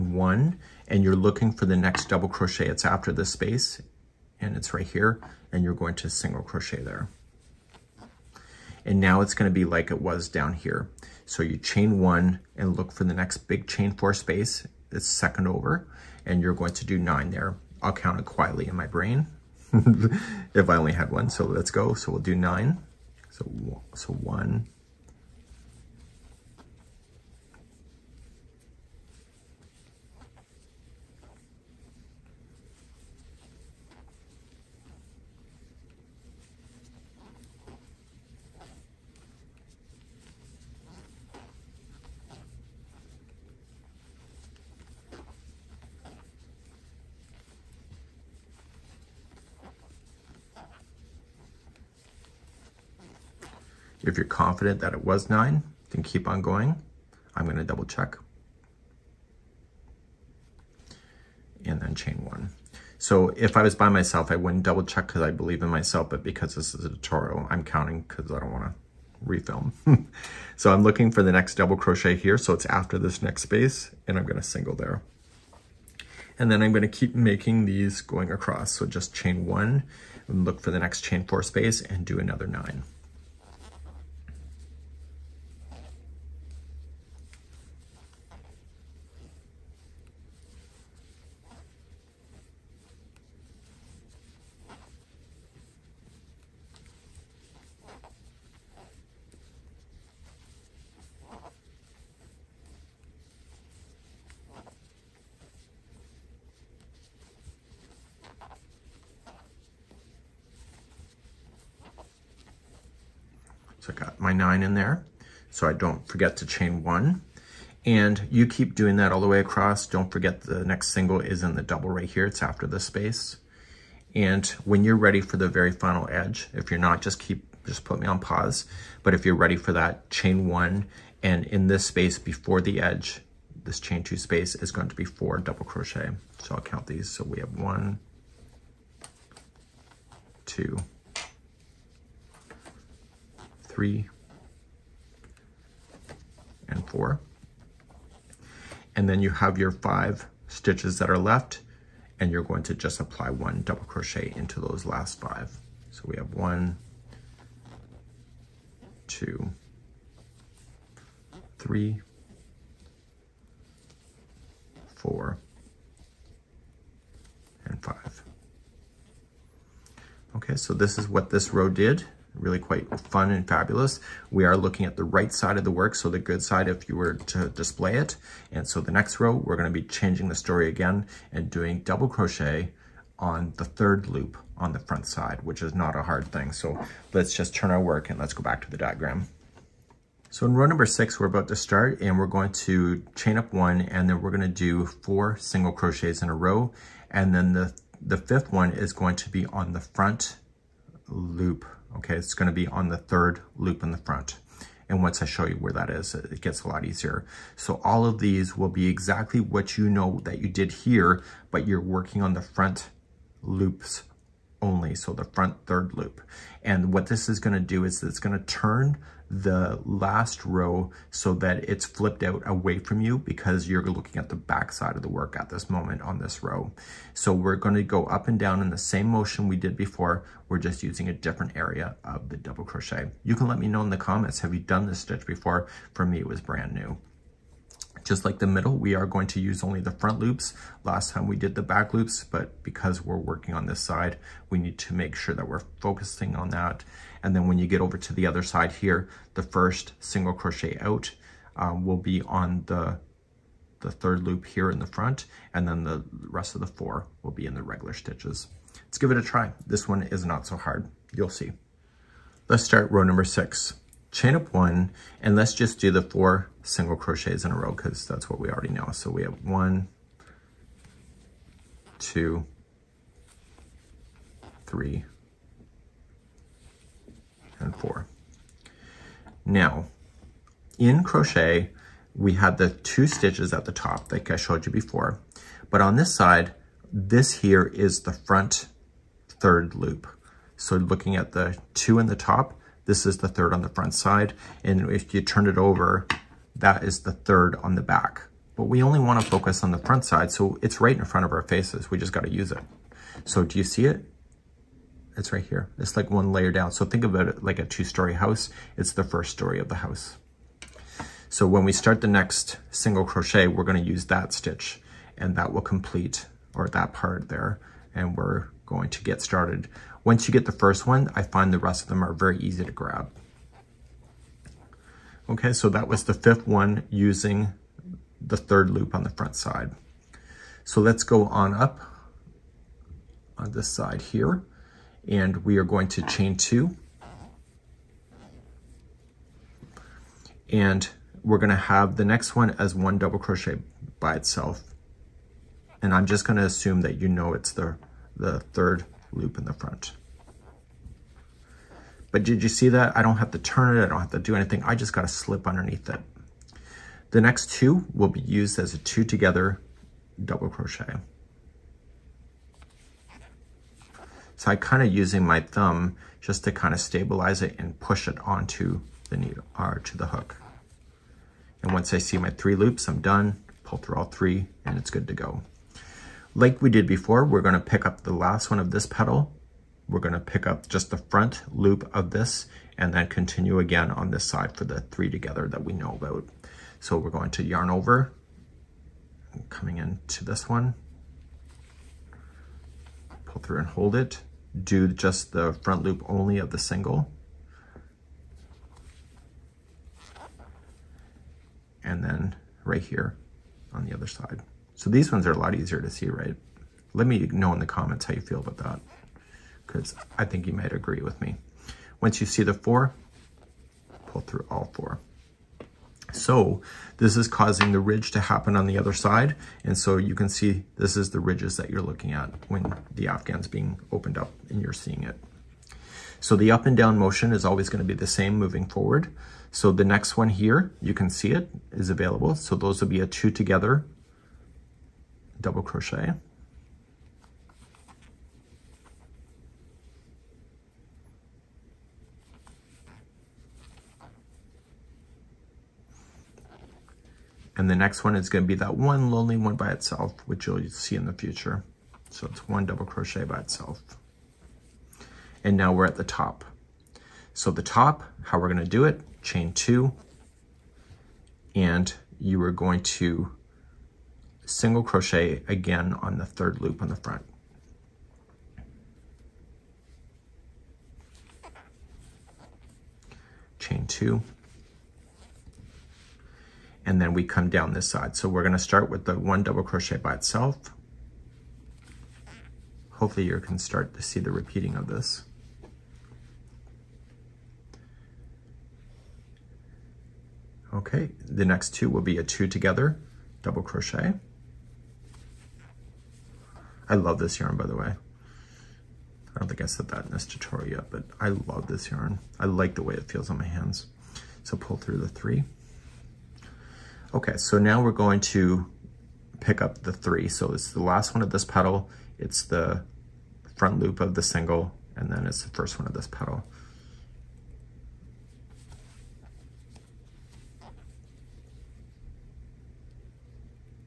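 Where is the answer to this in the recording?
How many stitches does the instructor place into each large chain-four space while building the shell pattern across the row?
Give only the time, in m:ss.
0:16.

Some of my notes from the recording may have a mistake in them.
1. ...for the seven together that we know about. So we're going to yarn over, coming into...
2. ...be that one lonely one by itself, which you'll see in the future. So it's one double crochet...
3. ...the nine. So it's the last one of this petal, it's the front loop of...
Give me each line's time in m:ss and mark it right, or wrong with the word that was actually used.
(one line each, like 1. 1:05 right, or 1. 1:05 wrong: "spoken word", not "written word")
1. 6:24 wrong: "three", not "seven"
2. 7:28 right
3. 8:29 wrong: "three", not "nine".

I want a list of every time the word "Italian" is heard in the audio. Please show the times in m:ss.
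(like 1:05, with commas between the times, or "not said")
not said.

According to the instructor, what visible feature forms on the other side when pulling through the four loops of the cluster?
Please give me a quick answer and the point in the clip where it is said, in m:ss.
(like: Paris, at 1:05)
ridge, at 6:57.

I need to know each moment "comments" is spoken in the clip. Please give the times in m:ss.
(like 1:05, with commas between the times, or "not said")
3:53, 6:47.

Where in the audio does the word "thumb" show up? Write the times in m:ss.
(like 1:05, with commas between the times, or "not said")
6:05.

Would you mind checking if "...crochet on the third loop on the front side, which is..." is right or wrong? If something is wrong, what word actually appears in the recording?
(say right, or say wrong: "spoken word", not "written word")
right.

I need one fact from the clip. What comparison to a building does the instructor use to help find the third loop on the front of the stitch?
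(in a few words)
two-story house.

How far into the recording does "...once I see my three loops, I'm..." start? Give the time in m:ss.
6:11.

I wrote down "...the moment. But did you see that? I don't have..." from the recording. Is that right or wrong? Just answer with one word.
wrong.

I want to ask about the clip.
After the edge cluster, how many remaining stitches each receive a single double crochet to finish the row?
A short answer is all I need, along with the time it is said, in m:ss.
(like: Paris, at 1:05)
5, at 2:29.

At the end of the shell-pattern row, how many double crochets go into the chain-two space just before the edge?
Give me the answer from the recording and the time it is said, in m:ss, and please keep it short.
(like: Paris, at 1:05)
4, at 2:15.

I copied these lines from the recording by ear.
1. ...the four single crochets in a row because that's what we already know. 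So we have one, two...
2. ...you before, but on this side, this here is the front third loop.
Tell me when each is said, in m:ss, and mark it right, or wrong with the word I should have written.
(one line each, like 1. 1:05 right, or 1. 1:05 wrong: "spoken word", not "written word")
1. 4:25 right
2. 4:44 right.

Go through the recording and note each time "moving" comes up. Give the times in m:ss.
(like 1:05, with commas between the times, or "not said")
7:08.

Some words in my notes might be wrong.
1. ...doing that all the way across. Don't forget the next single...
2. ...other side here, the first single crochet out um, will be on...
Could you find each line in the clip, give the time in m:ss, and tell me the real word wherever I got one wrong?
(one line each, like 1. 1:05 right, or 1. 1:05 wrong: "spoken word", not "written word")
1. 1:58 right
2. 4:08 right.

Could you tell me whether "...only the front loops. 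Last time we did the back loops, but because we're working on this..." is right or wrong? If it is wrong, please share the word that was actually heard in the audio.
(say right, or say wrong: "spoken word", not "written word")
right.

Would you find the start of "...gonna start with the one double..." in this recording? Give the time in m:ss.
7:58.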